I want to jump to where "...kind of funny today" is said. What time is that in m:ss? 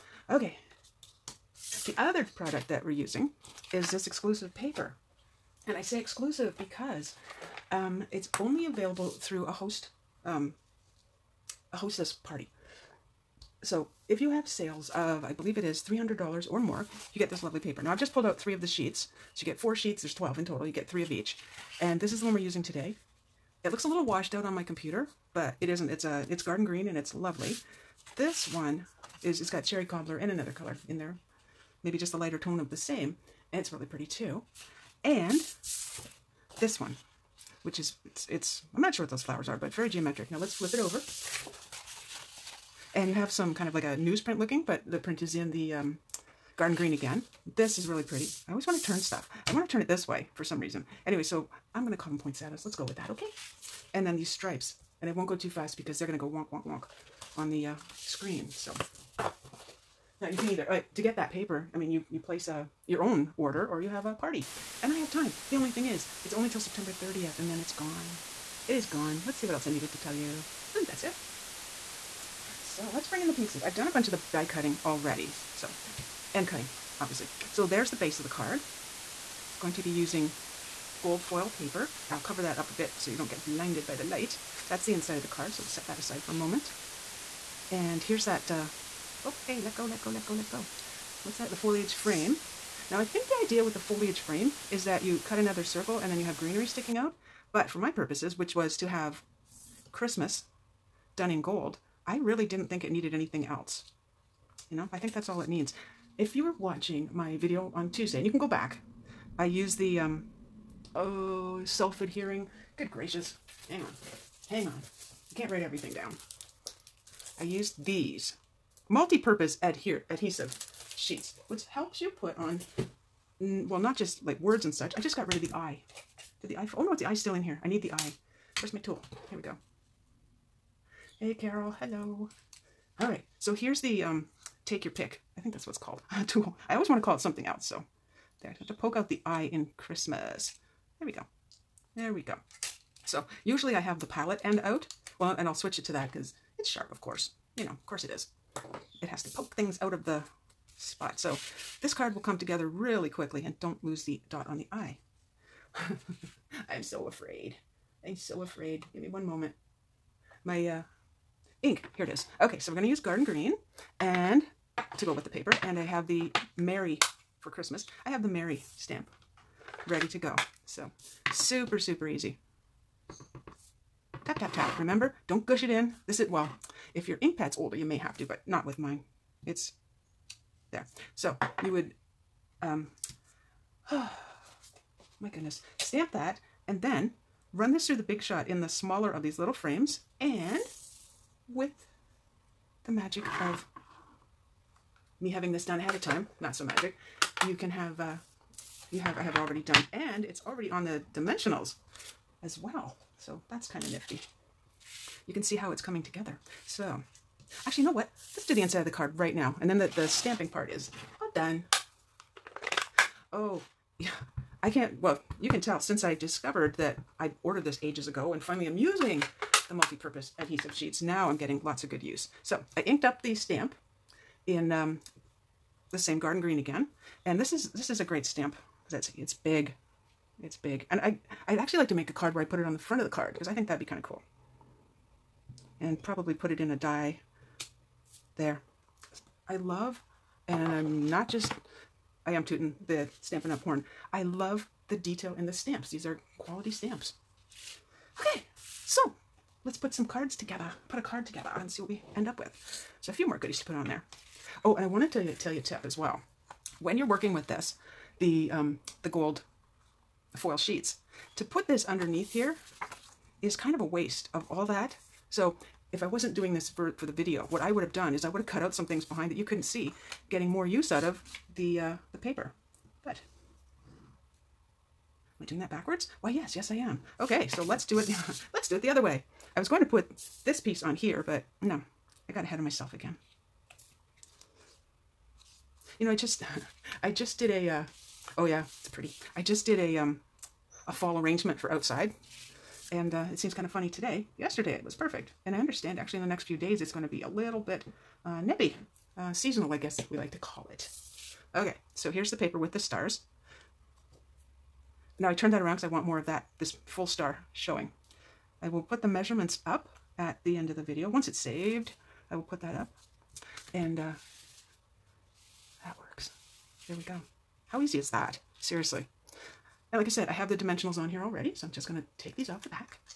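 4:53.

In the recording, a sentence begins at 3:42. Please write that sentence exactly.
So I inked up the stamp in um, the same garden green again.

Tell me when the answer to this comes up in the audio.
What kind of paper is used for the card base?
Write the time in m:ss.
1:21.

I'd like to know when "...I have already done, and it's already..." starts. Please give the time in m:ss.
3:19.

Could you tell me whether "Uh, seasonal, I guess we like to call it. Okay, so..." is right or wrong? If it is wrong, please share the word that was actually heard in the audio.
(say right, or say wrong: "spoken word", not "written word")
right.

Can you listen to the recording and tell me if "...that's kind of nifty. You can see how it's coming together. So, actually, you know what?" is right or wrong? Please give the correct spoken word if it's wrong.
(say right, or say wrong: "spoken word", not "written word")
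right.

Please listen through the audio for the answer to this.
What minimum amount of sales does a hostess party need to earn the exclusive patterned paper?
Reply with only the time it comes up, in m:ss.
0:15.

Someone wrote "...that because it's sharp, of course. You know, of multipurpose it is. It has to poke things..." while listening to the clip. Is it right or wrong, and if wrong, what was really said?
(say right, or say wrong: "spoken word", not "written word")
wrong: "course", not "multipurpose".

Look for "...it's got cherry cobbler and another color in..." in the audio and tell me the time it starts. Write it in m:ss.
0:29.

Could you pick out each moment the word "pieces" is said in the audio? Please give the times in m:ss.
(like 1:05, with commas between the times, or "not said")
1:13, 4:40.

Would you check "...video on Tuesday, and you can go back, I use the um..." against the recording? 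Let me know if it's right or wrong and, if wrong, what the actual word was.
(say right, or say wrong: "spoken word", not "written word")
right.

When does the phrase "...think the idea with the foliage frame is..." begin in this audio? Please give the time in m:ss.
1:33.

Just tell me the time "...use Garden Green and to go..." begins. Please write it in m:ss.
2:42.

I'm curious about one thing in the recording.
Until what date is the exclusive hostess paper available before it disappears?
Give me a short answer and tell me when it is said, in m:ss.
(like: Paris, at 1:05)
September 30th, at 1:06.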